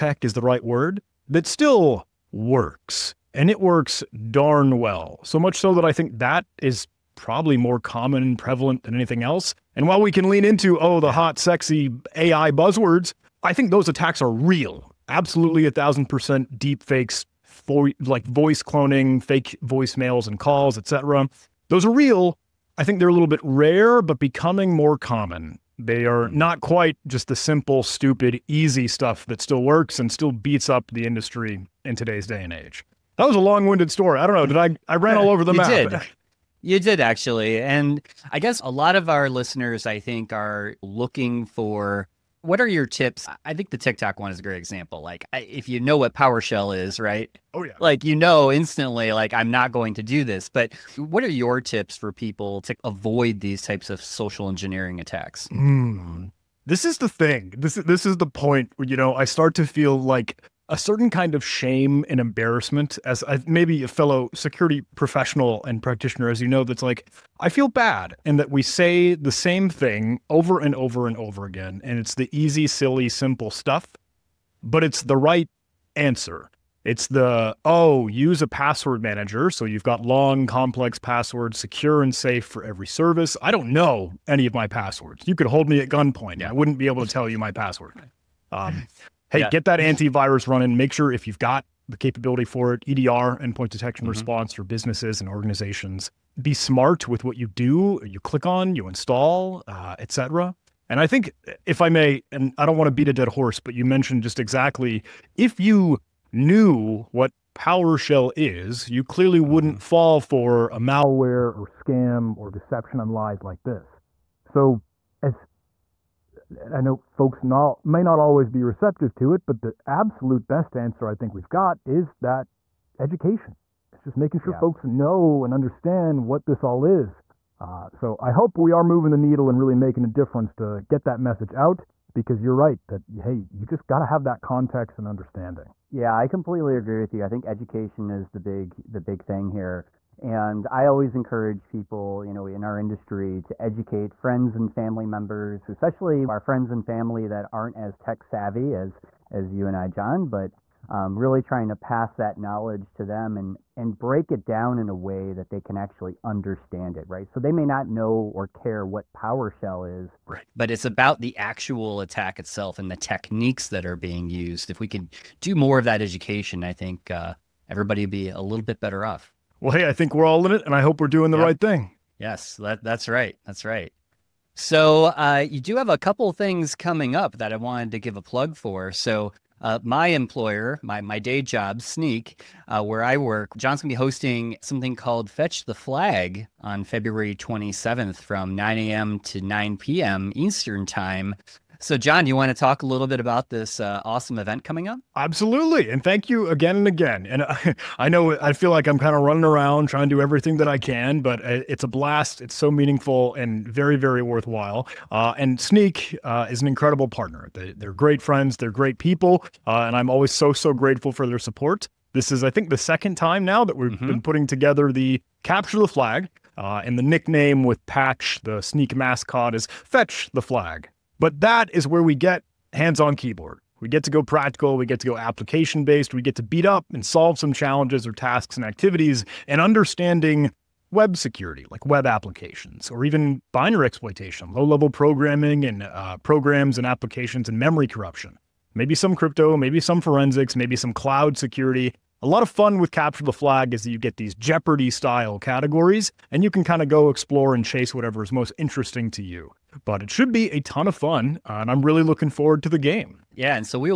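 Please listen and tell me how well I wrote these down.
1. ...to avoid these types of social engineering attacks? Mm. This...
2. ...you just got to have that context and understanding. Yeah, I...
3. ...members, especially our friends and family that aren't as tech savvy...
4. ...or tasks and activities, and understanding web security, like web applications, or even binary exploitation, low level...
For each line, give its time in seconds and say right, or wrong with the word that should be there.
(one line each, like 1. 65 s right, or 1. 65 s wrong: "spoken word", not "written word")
1. 52 s right
2. 133 s right
3. 145 s right
4. 228 s right.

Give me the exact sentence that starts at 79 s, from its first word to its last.
So you've got long, complex passwords, secure and safe for every service.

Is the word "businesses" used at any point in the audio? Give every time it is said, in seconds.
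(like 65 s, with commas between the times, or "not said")
94 s.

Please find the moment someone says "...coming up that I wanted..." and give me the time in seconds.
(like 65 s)
176 s.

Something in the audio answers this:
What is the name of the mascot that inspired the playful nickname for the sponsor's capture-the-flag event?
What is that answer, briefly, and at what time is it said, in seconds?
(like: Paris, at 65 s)
Patch, at 217 s.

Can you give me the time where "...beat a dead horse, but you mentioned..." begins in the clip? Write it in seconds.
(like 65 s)
102 s.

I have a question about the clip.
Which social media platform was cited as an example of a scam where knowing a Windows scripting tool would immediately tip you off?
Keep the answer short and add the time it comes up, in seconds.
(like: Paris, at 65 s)
TikTok, at 43 s.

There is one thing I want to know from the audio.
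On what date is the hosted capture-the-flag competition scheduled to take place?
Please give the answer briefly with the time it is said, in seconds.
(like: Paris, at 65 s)
February 27th, at 186 s.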